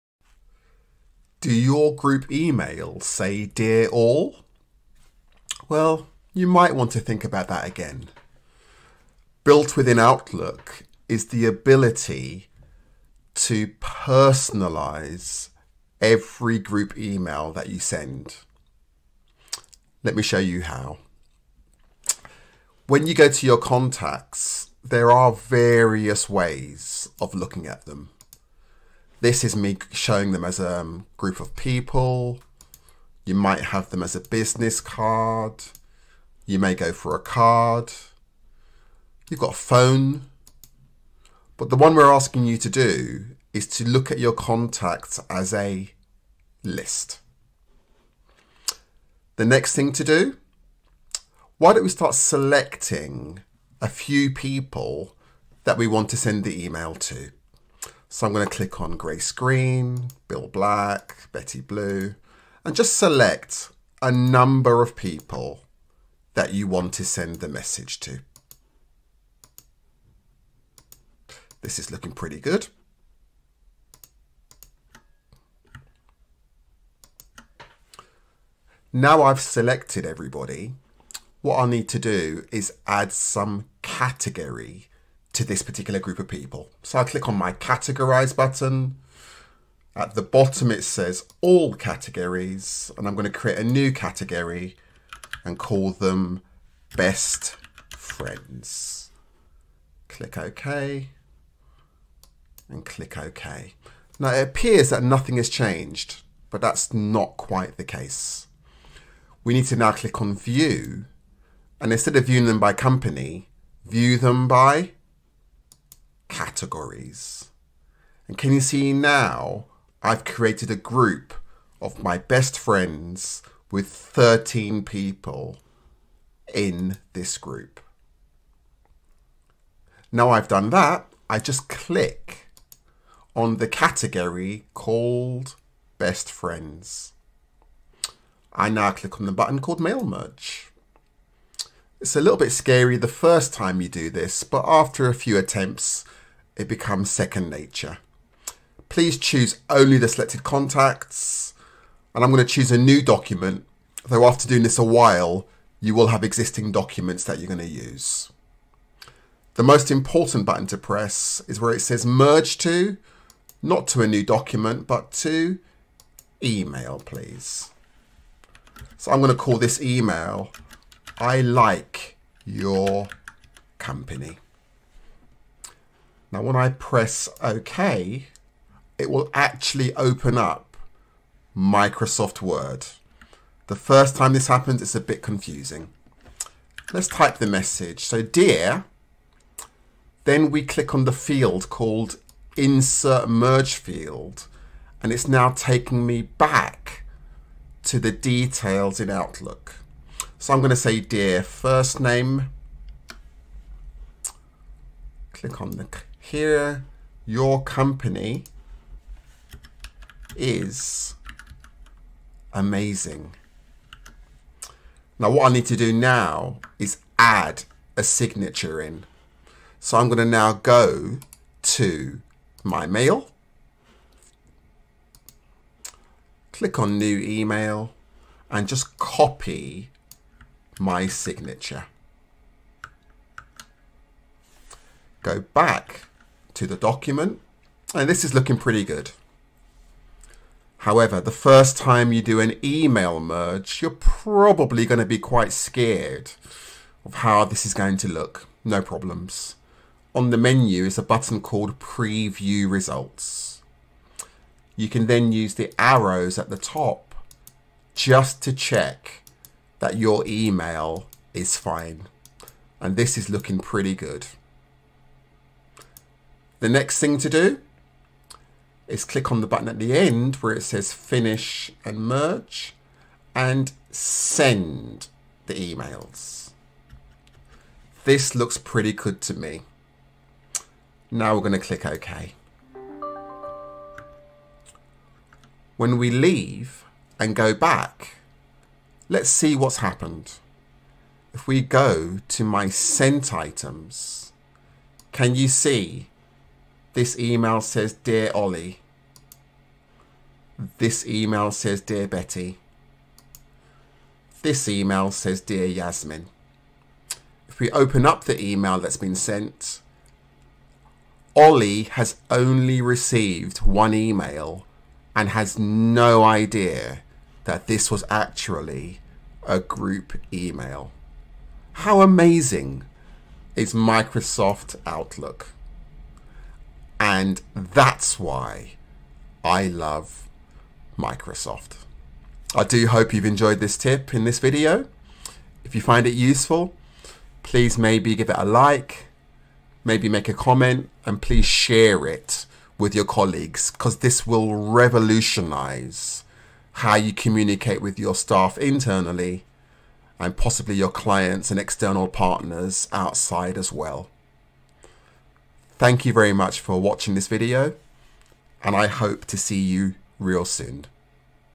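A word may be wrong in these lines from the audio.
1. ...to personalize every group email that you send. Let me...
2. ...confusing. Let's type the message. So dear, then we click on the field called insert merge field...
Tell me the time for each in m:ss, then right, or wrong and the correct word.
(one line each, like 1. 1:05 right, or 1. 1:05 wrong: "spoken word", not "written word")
1. 0:13 right
2. 3:05 right.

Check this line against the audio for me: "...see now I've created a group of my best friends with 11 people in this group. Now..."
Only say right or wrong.
wrong.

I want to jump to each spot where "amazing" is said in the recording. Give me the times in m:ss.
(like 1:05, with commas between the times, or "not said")
3:32, 5:22.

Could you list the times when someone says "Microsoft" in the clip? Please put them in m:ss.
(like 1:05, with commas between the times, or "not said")
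3:01, 5:23, 5:30.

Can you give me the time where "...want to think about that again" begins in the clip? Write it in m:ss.
0:06.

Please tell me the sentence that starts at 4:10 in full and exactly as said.
On the menu is a button called Preview Results.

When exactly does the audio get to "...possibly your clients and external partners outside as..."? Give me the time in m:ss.
5:50.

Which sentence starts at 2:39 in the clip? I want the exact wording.
The most important button to press is where it says merge to, not to a new document, but to email, please.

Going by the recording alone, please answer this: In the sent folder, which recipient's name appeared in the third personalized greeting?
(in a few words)
Yasmin.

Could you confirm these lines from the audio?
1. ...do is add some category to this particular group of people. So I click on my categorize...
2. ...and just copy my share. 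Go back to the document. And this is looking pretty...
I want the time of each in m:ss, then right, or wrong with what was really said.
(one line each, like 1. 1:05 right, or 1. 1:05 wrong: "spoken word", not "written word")
1. 1:21 right
2. 3:48 wrong: "signature", not "share".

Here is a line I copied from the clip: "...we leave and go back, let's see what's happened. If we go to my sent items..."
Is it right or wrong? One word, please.
right.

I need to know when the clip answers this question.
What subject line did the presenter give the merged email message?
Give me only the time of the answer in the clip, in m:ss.
2:51.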